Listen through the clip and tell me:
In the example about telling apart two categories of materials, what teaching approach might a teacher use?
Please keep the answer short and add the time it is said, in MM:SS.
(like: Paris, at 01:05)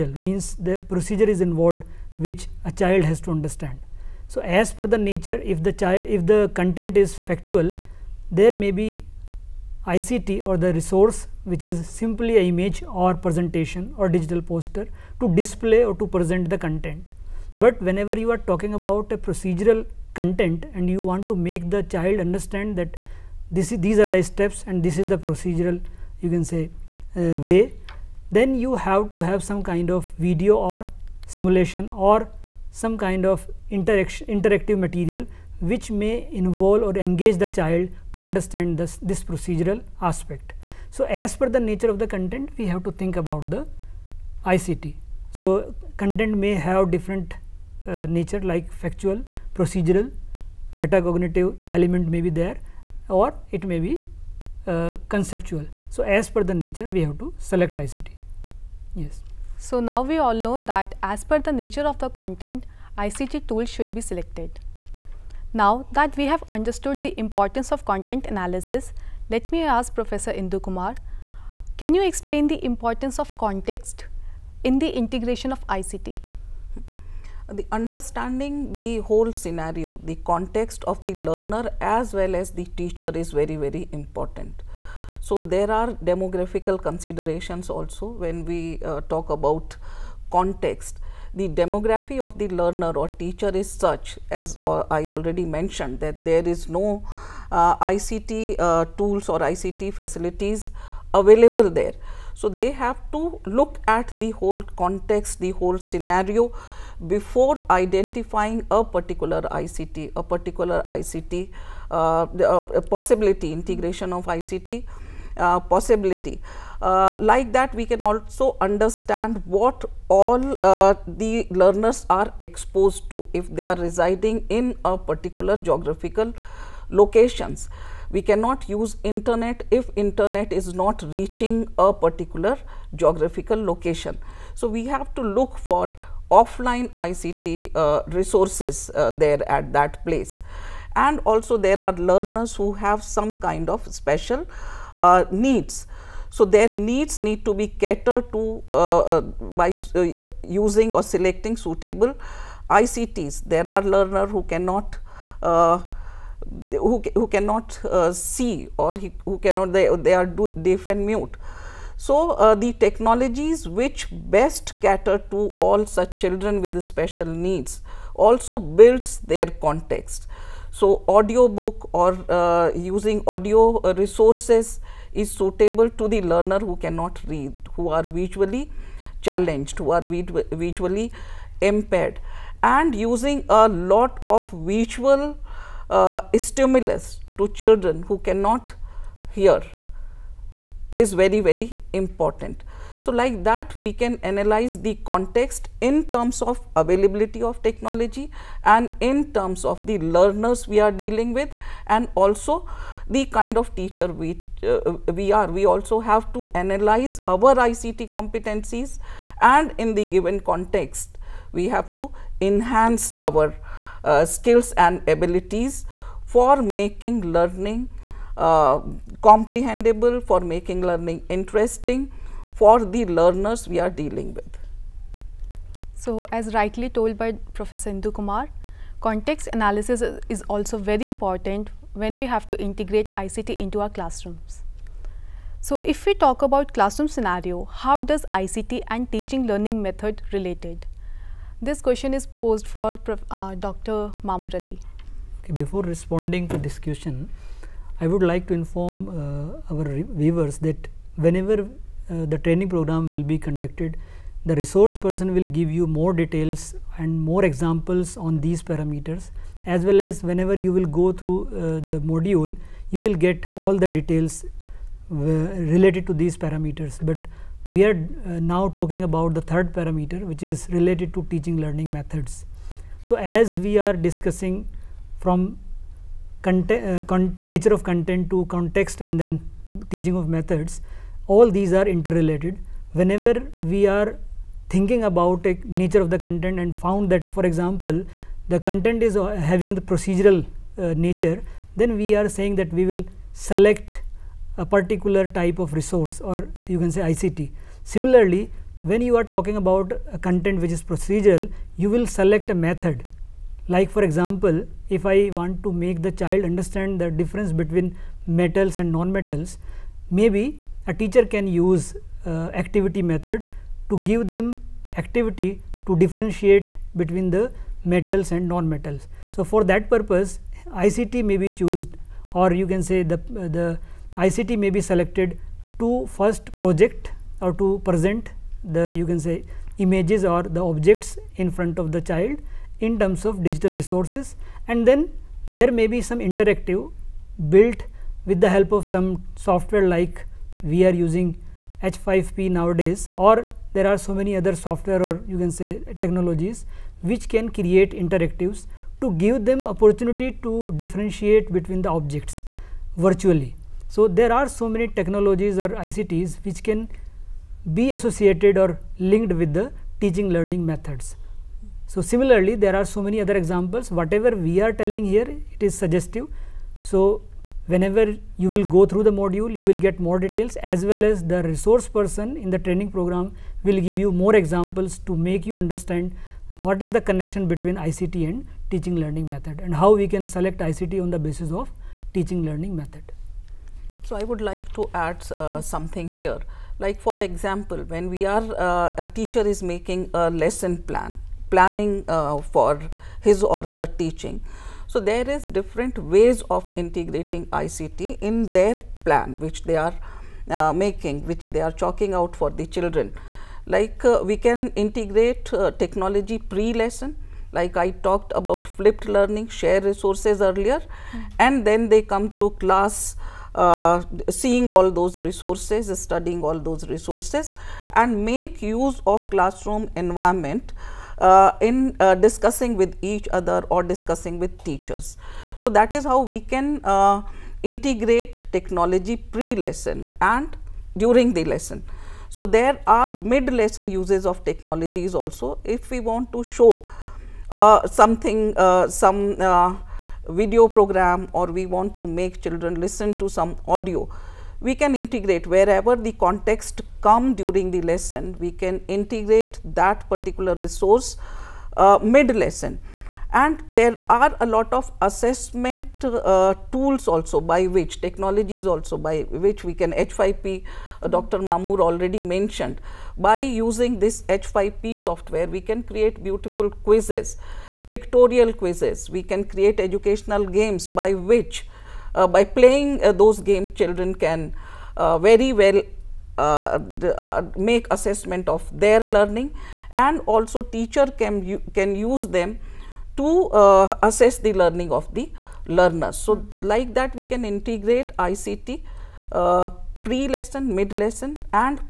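activity method, at 05:12.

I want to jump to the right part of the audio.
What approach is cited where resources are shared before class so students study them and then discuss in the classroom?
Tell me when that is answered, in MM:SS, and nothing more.
06:48.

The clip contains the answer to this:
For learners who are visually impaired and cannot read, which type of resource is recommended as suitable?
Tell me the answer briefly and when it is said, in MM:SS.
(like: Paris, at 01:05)
audiobook, at 02:51.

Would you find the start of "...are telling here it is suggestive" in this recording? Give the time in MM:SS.
06:04.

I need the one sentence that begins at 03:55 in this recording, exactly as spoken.
So, if we talk about classroom scenario, how does ICT and teaching learning method related?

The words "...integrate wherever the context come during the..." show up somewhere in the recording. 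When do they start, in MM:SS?
07:24.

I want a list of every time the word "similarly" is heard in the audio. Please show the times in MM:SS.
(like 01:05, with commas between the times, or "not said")
04:57, 06:02.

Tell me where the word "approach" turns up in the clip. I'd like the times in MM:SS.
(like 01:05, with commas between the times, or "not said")
not said.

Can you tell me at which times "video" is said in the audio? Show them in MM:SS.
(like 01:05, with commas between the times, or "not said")
00:30, 07:20.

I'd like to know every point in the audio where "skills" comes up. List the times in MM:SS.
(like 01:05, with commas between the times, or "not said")
03:34.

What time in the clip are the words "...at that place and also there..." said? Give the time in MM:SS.
02:19.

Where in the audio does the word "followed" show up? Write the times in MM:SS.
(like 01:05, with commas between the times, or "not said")
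not said.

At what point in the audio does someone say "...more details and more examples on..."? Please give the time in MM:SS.
04:15.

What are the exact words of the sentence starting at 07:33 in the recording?
And there are a lot of assessment uh, tools also by which technologies also by which we can H5P, uh, Dr.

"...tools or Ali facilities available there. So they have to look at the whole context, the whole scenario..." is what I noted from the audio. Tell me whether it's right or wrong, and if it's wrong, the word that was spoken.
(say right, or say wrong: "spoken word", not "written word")
wrong: "ICT", not "Ali".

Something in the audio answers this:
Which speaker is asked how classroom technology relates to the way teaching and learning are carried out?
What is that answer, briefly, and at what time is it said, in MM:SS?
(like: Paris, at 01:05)
Dr. Mamur Ali, at 04:03.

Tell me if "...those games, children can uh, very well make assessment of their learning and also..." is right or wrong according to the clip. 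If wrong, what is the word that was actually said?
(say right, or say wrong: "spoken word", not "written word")
right.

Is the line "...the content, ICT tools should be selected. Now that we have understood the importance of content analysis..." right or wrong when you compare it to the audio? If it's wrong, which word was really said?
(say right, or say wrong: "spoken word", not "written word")
right.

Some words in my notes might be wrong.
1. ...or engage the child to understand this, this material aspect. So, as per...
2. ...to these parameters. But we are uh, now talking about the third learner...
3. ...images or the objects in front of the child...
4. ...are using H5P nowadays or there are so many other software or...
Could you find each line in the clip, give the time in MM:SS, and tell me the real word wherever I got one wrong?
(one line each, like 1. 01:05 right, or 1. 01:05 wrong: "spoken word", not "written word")
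1. 00:36 wrong: "procedural", not "material"
2. 04:26 wrong: "parameter", not "learner"
3. 05:29 right
4. 05:40 right.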